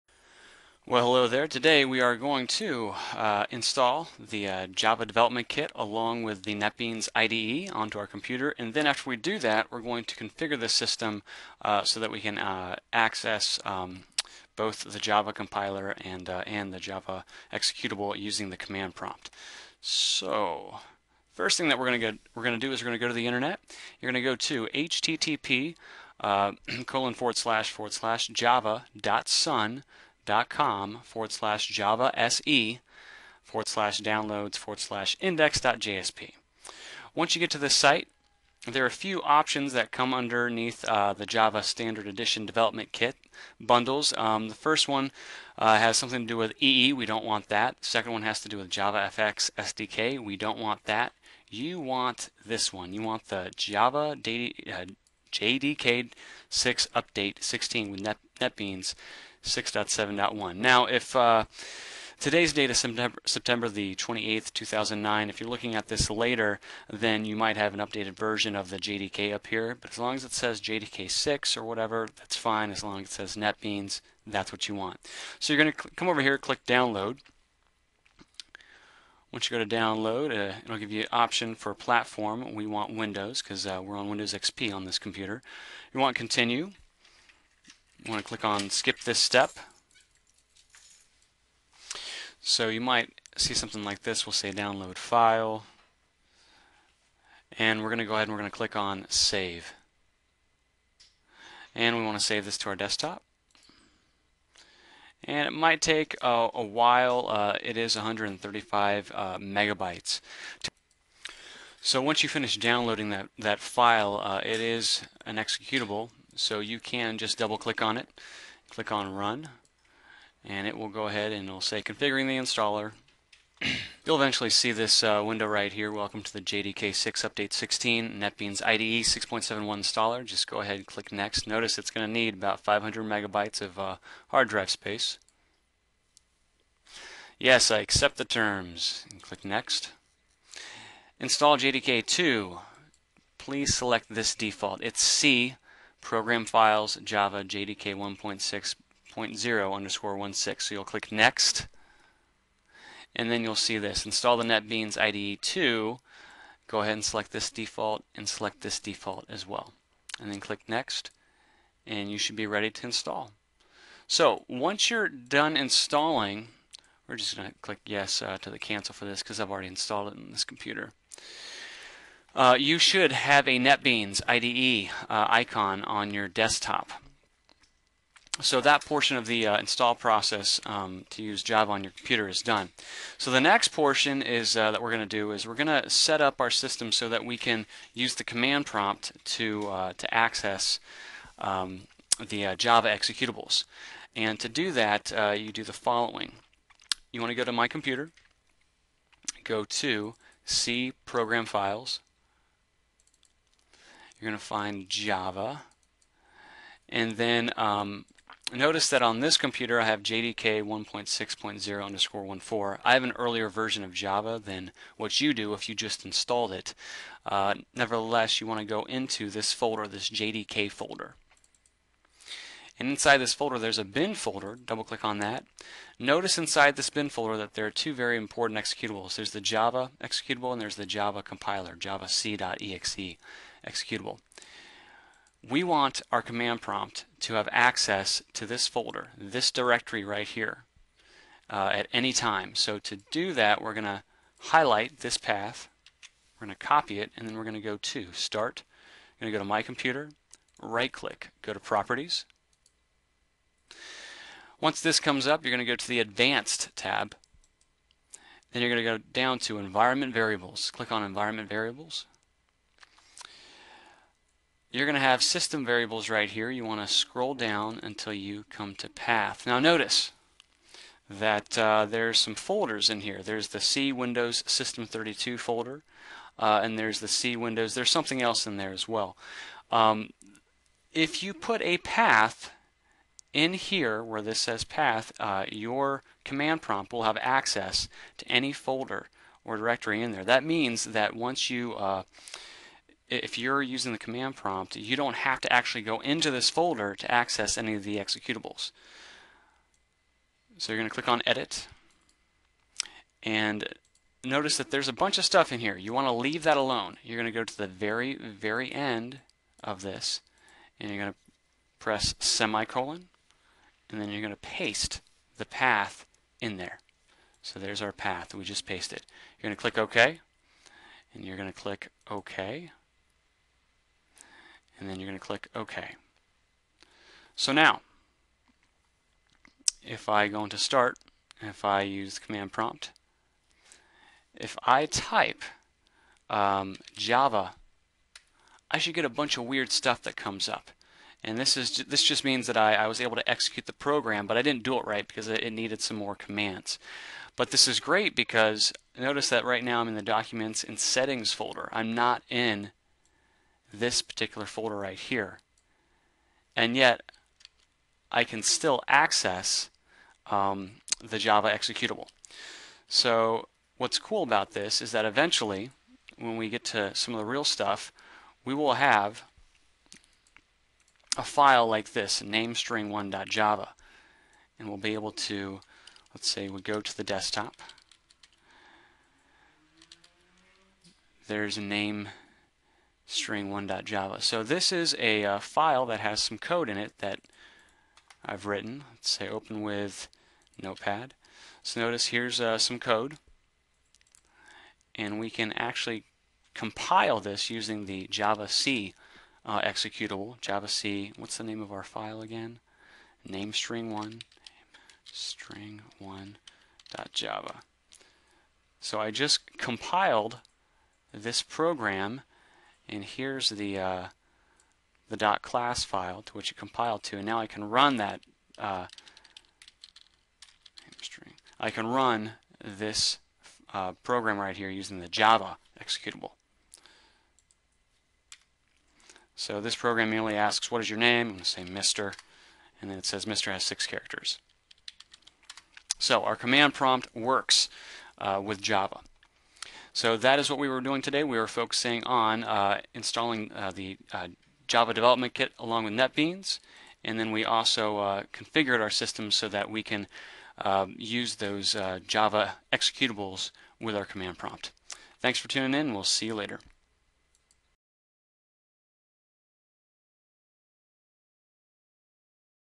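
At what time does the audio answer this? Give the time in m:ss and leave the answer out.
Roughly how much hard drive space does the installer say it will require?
2:12.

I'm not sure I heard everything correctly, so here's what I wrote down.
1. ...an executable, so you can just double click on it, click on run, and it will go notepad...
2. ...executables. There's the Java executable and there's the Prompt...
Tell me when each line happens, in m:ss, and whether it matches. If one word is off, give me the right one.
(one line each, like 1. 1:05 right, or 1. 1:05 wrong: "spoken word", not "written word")
1. 1:55 wrong: "ahead", not "notepad"
2. 3:48 wrong: "Java", not "Prompt".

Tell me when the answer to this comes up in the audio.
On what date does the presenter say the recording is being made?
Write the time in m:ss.
1:03.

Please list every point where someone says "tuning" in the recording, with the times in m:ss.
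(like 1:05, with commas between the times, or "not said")
7:35.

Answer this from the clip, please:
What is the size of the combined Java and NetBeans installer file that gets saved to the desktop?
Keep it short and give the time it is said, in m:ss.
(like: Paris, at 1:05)
135 megabytes, at 1:47.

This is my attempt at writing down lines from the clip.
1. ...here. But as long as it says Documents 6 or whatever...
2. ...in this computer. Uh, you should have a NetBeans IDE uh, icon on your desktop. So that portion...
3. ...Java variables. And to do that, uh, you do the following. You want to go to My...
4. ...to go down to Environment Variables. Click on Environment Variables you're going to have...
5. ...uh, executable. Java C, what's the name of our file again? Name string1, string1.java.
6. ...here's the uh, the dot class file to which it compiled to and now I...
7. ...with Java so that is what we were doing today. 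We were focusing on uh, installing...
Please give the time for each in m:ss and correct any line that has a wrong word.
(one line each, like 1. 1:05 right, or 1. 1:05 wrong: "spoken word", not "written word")
1. 1:09 wrong: "JDK", not "Documents"
2. 2:50 right
3. 3:12 wrong: "executables", not "variables"
4. 4:18 right
5. 6:39 right
6. 6:53 right
7. 7:18 right.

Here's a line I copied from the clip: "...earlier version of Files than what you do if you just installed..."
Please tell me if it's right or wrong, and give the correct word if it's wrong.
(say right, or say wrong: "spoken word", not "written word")
wrong: "Java", not "Files".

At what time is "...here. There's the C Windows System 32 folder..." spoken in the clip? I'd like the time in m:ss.
4:33.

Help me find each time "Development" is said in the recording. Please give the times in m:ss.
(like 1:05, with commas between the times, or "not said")
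0:05, 0:42, 7:24.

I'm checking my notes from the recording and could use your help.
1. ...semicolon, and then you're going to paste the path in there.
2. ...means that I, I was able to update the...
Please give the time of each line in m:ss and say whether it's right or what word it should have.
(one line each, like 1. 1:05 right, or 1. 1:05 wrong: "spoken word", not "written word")
1. 5:12 right
2. 5:42 wrong: "execute", not "update".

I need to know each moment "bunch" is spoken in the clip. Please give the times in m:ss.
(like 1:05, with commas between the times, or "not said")
5:04, 5:39.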